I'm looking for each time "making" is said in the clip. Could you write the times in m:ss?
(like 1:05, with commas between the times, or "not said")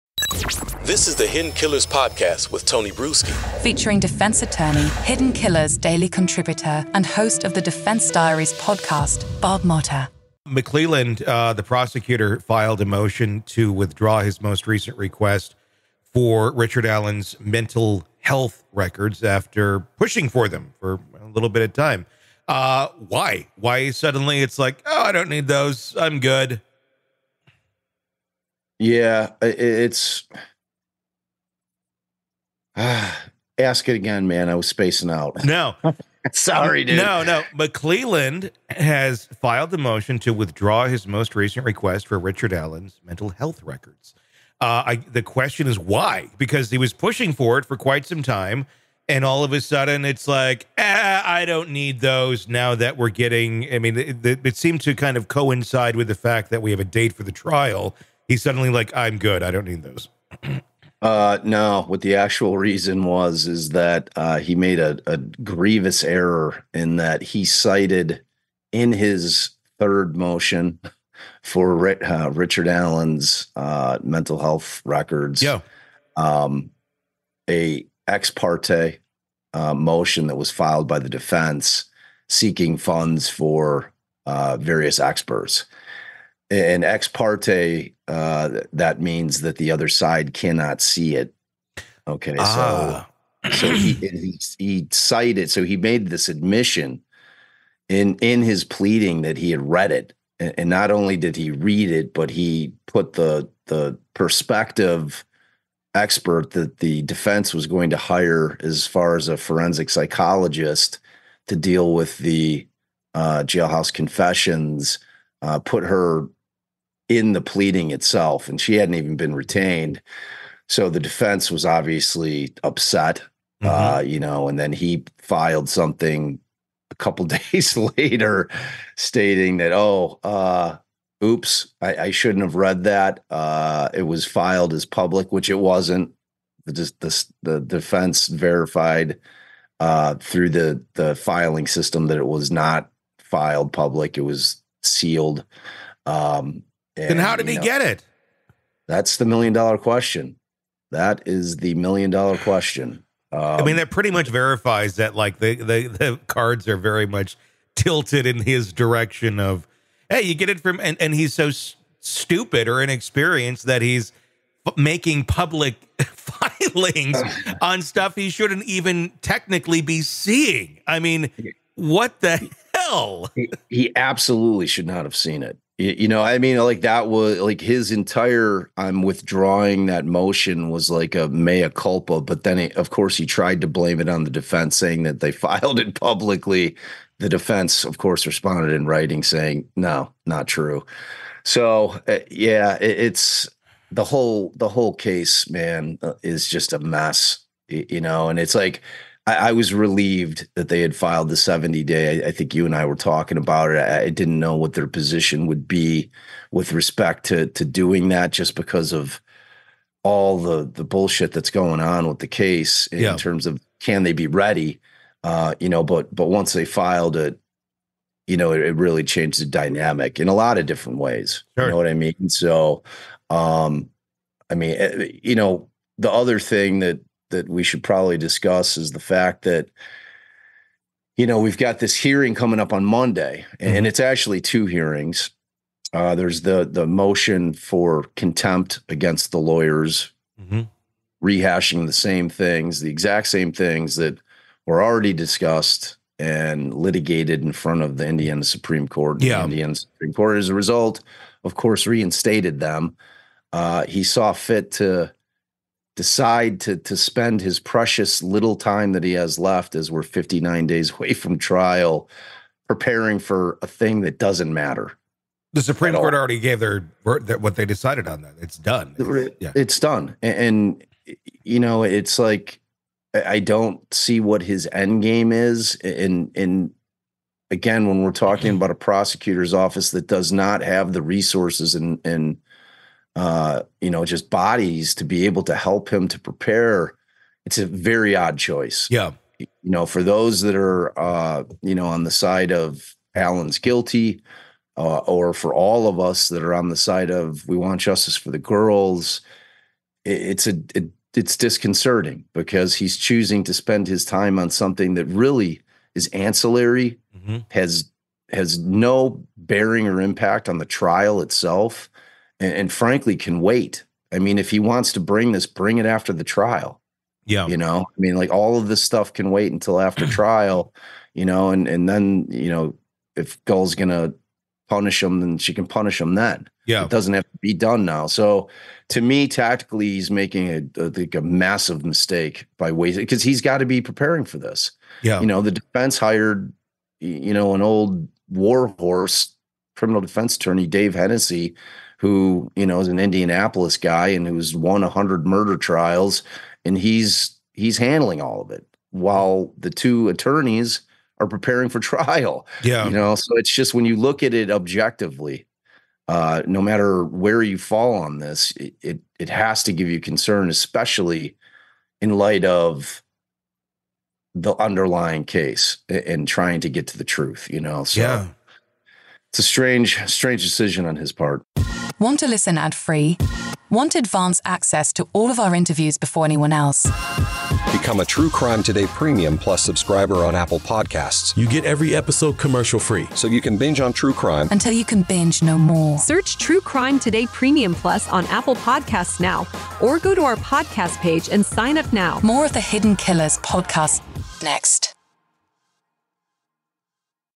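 2:44, 5:30.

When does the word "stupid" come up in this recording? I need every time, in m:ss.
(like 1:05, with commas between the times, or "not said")
2:42.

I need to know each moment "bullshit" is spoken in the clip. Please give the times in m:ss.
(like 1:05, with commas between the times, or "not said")
3:30.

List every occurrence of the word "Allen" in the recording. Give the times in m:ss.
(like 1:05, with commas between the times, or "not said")
0:16, 0:42, 1:12, 4:53.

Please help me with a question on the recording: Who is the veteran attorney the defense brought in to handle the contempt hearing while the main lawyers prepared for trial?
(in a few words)
Dave Hennessy.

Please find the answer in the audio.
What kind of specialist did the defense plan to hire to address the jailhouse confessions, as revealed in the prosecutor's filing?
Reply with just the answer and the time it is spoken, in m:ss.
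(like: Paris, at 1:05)
Forensic psychologist, at 1:49.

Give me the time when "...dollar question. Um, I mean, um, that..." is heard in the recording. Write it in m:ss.
2:32.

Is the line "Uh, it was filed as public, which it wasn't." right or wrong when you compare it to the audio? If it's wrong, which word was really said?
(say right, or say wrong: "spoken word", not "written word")
right.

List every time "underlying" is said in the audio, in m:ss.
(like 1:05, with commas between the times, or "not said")
6:04.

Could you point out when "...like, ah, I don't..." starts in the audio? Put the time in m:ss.
0:50.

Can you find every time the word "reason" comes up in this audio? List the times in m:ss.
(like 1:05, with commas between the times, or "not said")
1:02.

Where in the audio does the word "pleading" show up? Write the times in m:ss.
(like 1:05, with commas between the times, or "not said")
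1:38, 1:57.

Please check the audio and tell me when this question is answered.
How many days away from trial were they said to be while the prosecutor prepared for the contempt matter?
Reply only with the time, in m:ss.
4:20.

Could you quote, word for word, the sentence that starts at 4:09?
Yeah, the Indiana Supreme Court, as a result, of course, reinstated them.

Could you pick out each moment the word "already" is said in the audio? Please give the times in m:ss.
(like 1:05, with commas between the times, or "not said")
4:04, 4:26.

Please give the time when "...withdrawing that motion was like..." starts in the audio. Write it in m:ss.
2:59.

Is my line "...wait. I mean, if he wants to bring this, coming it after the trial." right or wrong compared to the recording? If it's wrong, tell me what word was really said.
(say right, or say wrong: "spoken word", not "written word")
wrong: "bring", not "coming".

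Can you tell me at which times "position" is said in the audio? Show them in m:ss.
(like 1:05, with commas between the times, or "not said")
3:24.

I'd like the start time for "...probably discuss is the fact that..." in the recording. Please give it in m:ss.
3:47.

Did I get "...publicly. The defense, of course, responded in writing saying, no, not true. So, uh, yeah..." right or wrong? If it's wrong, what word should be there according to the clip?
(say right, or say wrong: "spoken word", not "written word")
right.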